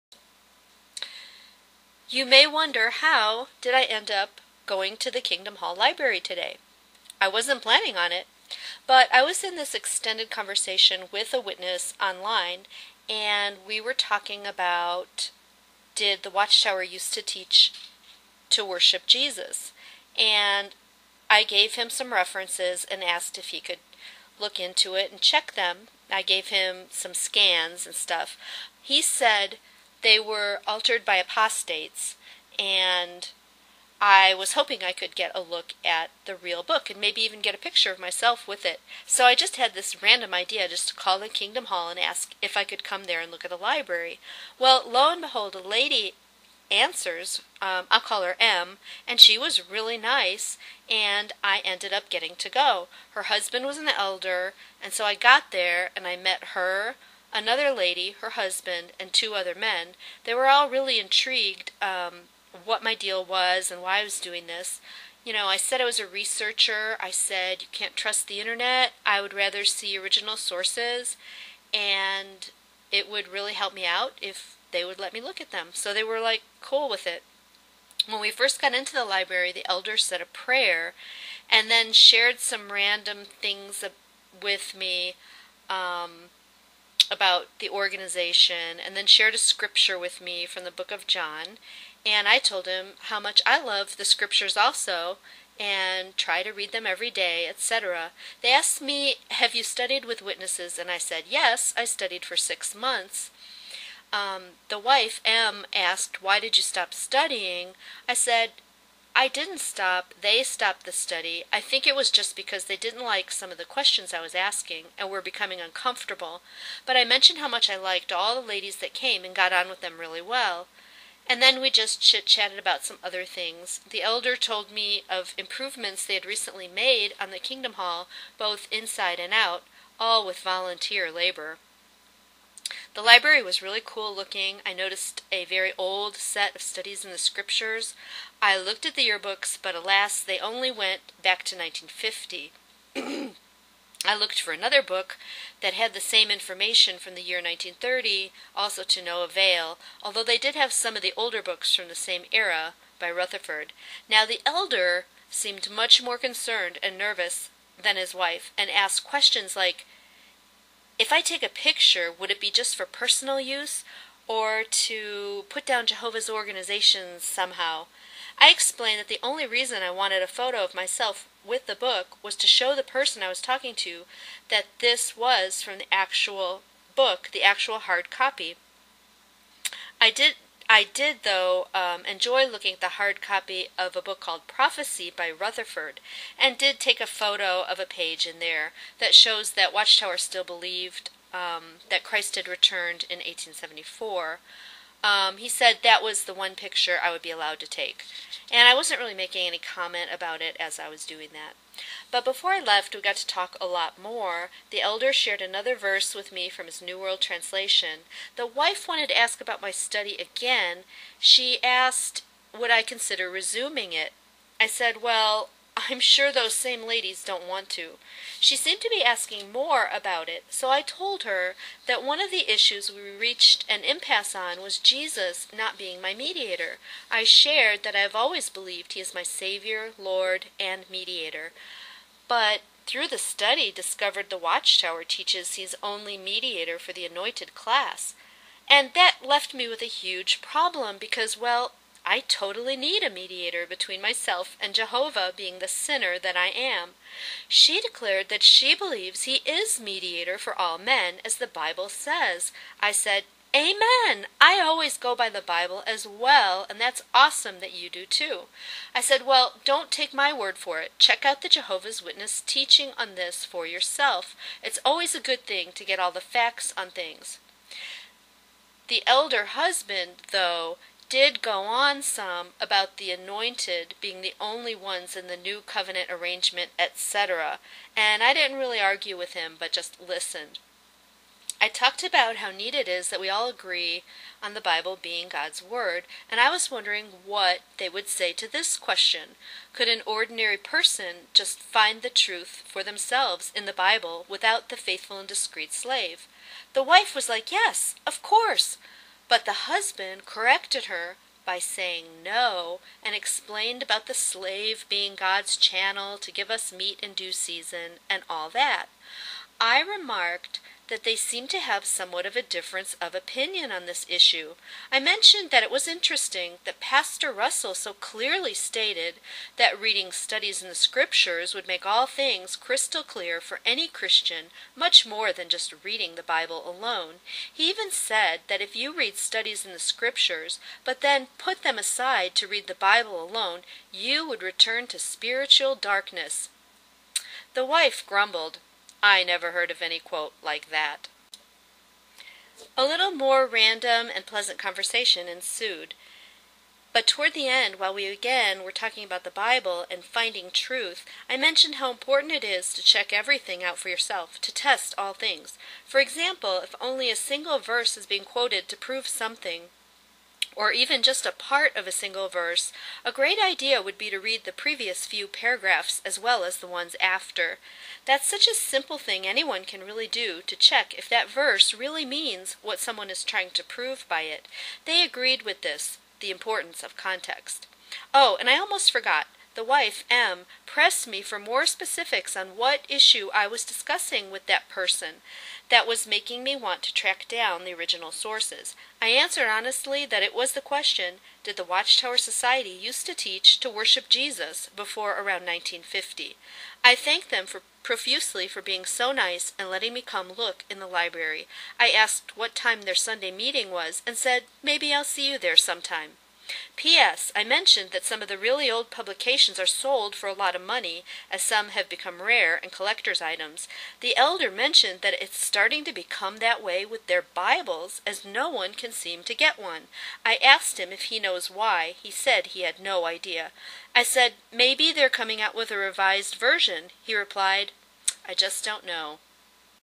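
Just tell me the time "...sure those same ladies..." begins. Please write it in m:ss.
3:36.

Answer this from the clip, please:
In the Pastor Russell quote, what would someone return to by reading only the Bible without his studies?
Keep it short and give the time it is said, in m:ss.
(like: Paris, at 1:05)
spiritual darkness, at 5:34.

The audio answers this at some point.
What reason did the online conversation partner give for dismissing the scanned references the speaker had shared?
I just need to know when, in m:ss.
0:30.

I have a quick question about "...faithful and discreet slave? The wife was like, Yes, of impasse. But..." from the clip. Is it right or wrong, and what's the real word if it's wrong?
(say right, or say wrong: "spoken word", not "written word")
wrong: "course", not "impasse".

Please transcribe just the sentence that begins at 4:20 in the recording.
Check out the Jehovah's Witness teaching on this for yourself.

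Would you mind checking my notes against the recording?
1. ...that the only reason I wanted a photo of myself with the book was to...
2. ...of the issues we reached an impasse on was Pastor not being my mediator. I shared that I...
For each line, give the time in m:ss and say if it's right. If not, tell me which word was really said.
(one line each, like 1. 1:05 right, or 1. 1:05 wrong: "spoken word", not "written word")
1. 2:48 right
2. 3:42 wrong: "Jesus", not "Pastor".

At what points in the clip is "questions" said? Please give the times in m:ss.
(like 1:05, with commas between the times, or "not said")
1:53, 2:39, 4:48, 6:30.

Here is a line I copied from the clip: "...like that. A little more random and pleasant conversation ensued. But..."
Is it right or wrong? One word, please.
right.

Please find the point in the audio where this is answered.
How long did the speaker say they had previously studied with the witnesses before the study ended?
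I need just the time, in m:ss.
1:42.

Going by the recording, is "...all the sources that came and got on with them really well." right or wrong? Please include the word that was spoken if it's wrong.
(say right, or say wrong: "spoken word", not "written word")
wrong: "ladies", not "sources".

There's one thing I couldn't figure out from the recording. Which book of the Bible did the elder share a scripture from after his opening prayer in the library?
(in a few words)
John.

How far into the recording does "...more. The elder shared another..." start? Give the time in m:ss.
3:24.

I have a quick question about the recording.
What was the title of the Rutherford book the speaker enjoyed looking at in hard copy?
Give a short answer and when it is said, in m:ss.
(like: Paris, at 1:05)
Prophecy, at 3:04.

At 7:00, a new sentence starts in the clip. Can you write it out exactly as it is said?
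I asked him if he knows why.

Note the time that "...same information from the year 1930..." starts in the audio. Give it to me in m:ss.
2:26.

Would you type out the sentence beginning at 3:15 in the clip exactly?
Um, he said that was the one picture I would be allowed to take.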